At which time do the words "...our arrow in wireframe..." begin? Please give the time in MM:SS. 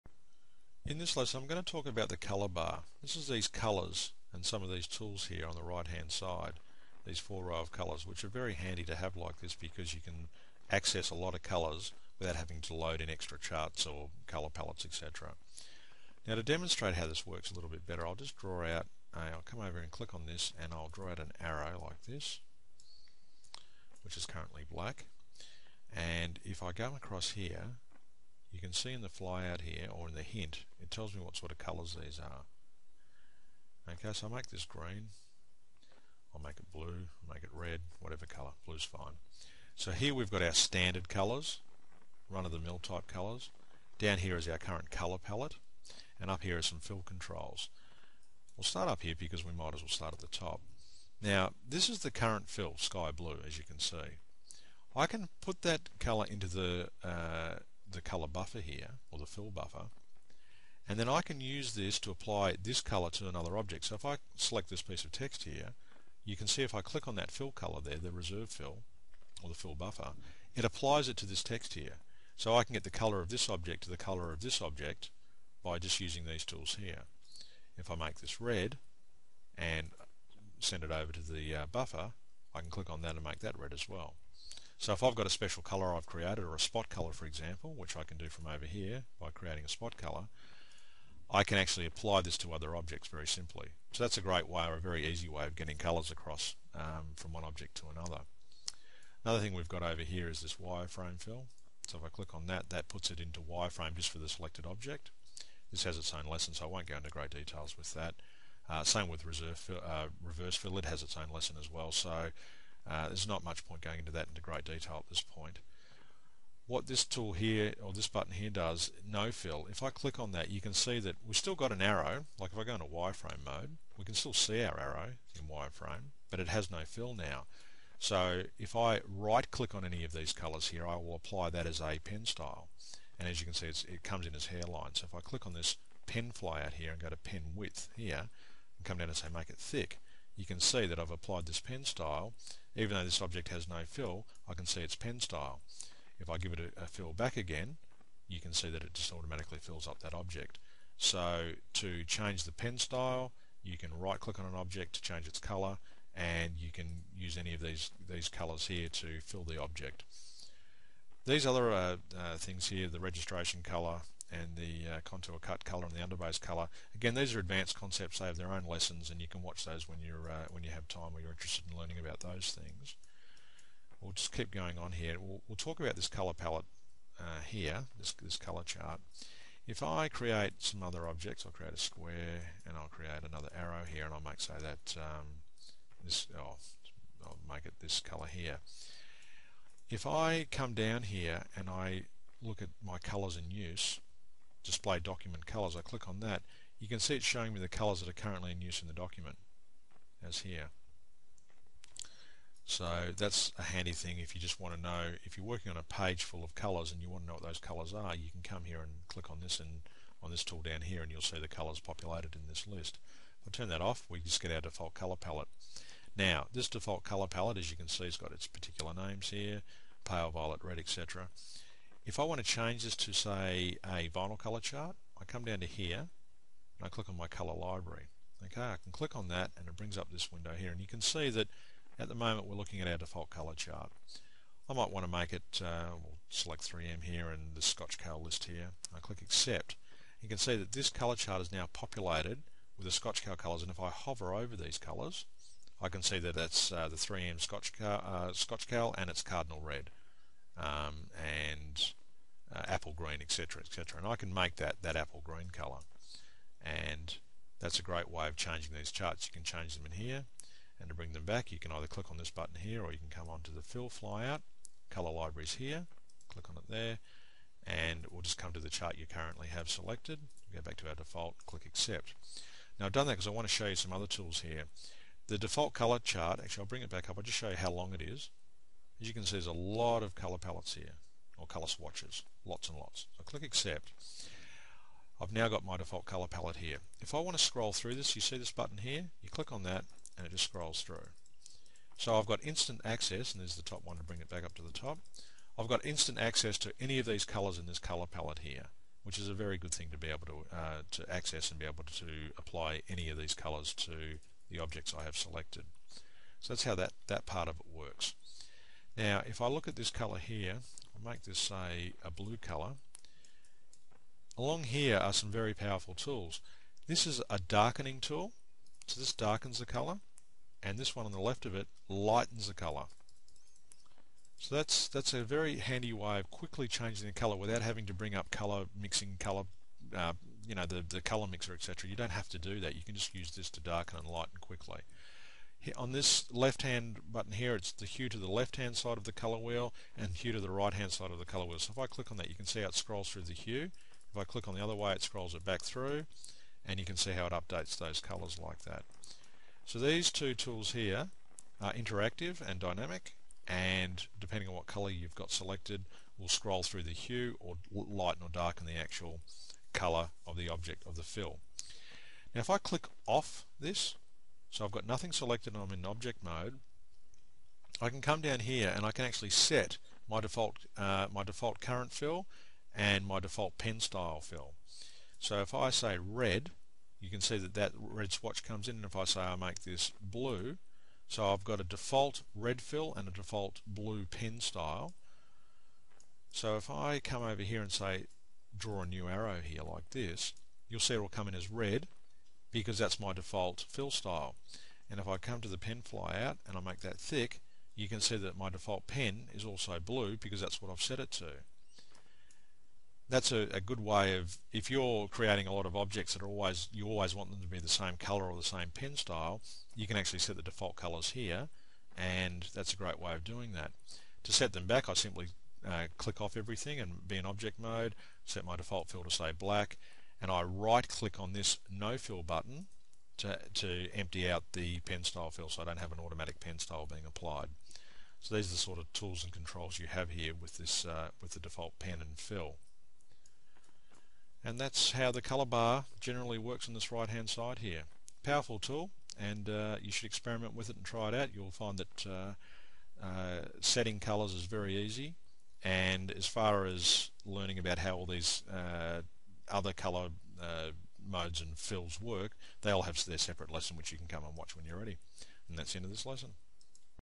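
02:04.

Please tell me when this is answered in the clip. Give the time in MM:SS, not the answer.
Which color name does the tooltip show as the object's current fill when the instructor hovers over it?
00:52.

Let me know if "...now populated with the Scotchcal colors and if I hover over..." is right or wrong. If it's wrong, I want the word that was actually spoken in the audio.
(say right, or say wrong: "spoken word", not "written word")
right.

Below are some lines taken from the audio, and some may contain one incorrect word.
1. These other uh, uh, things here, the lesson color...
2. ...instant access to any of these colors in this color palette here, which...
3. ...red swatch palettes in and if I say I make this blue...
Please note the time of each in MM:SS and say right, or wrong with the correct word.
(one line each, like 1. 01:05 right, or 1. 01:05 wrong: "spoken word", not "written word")
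1. 02:41 wrong: "registration", not "lesson"
2. 04:55 right
3. 06:17 wrong: "comes", not "palettes".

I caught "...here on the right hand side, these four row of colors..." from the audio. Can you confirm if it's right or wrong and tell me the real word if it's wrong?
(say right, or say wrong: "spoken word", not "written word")
right.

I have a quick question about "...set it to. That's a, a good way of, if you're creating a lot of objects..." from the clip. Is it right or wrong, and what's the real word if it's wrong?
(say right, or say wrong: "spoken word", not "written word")
right.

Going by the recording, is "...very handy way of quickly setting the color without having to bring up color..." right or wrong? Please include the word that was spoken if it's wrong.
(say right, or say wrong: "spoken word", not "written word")
wrong: "changing", not "setting".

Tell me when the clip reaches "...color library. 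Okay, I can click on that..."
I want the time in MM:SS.
03:47.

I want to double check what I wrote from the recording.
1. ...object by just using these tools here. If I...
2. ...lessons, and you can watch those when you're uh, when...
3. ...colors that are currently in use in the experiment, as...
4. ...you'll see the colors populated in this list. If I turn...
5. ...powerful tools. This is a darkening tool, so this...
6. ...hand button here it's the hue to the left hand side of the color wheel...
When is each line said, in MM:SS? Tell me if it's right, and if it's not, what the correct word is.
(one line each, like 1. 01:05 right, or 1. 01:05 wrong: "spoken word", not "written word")
1. 01:14 right
2. 02:48 right
3. 03:17 wrong: "document", not "experiment"
4. 03:31 right
5. 05:15 right
6. 05:36 right.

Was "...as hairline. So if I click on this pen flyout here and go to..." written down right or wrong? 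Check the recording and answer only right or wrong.
right.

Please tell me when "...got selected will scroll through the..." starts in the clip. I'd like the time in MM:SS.
05:55.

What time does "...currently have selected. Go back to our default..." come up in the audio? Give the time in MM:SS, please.
04:29.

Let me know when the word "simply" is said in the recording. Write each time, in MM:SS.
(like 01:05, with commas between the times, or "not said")
01:33, 06:54.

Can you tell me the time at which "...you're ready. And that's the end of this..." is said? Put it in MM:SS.
07:34.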